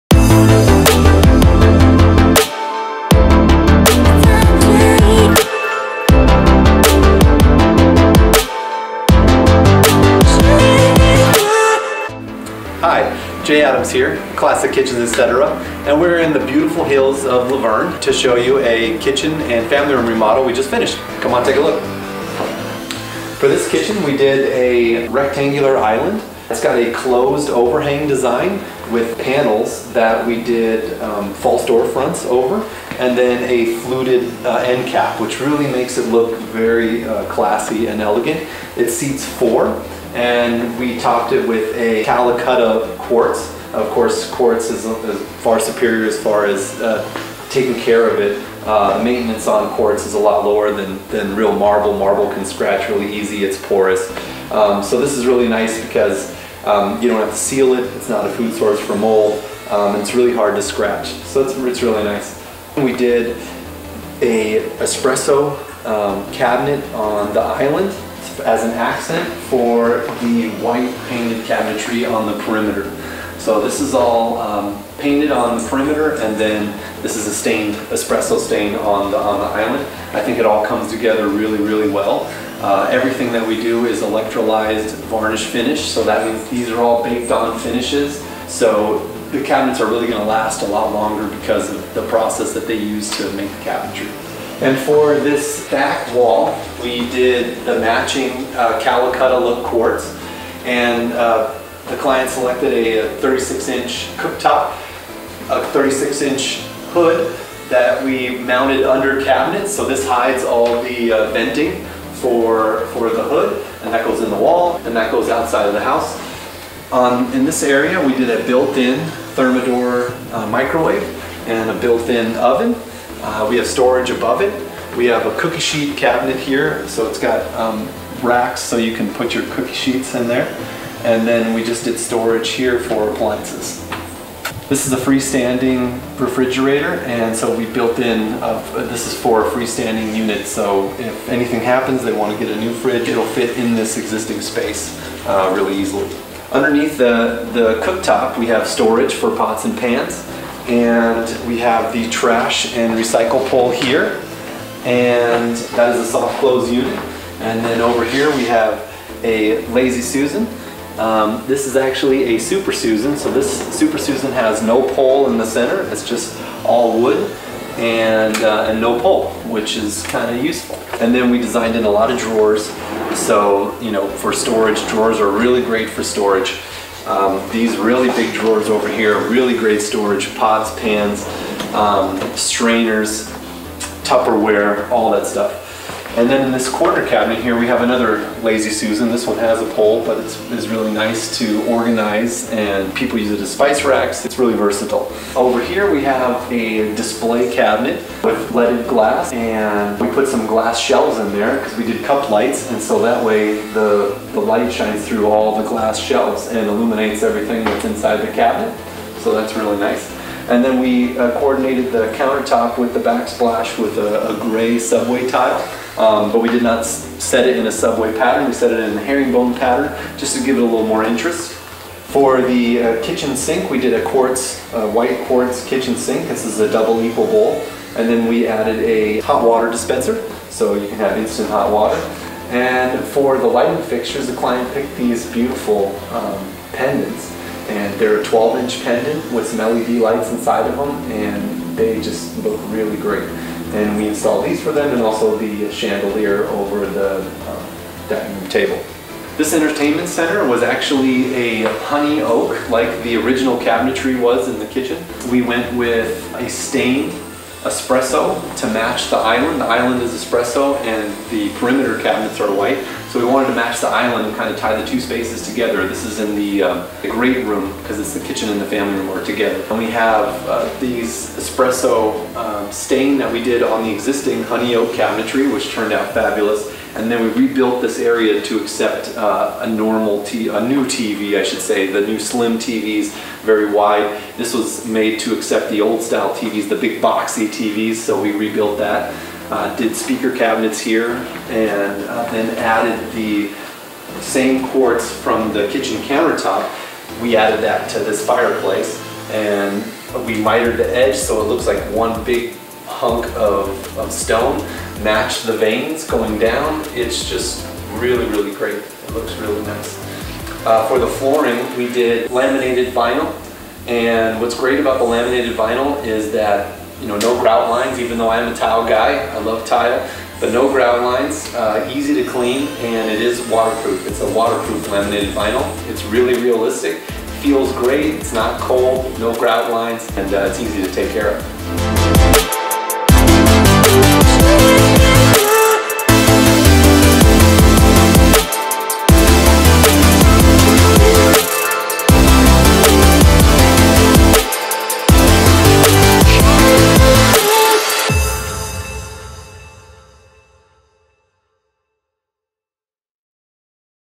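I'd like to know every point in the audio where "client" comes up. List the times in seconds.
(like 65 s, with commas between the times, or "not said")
101 s, 234 s.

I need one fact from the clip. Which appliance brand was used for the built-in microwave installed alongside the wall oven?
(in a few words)
Thermador.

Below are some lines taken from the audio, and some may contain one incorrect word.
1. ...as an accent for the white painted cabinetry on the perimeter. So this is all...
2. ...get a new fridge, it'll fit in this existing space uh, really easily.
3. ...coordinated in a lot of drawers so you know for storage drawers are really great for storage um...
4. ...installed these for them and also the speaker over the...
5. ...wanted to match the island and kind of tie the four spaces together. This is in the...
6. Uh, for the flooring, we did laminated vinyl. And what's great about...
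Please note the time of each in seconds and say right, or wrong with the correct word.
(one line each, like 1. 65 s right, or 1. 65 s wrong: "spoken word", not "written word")
1. 68 s right
2. 142 s right
3. 171 s wrong: "designed", not "coordinated"
4. 244 s wrong: "chandelier", not "speaker"
5. 263 s wrong: "two", not "four"
6. 310 s right.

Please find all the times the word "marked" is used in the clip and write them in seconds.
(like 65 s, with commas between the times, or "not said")
not said.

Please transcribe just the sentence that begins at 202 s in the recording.
And so that way the, the light shines through all the glass shelves and illuminates everything that's inside the cabinet.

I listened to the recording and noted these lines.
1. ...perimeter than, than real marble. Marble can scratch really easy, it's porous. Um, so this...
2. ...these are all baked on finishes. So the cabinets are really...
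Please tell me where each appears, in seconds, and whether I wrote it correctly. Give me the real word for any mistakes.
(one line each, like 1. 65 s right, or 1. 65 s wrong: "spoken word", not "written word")
1. 50 s wrong: "lower", not "perimeter"
2. 86 s right.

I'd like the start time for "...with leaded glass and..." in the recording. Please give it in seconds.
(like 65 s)
198 s.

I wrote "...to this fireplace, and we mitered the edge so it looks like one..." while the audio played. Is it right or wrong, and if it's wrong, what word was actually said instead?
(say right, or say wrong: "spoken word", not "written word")
right.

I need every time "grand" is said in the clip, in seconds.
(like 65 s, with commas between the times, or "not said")
not said.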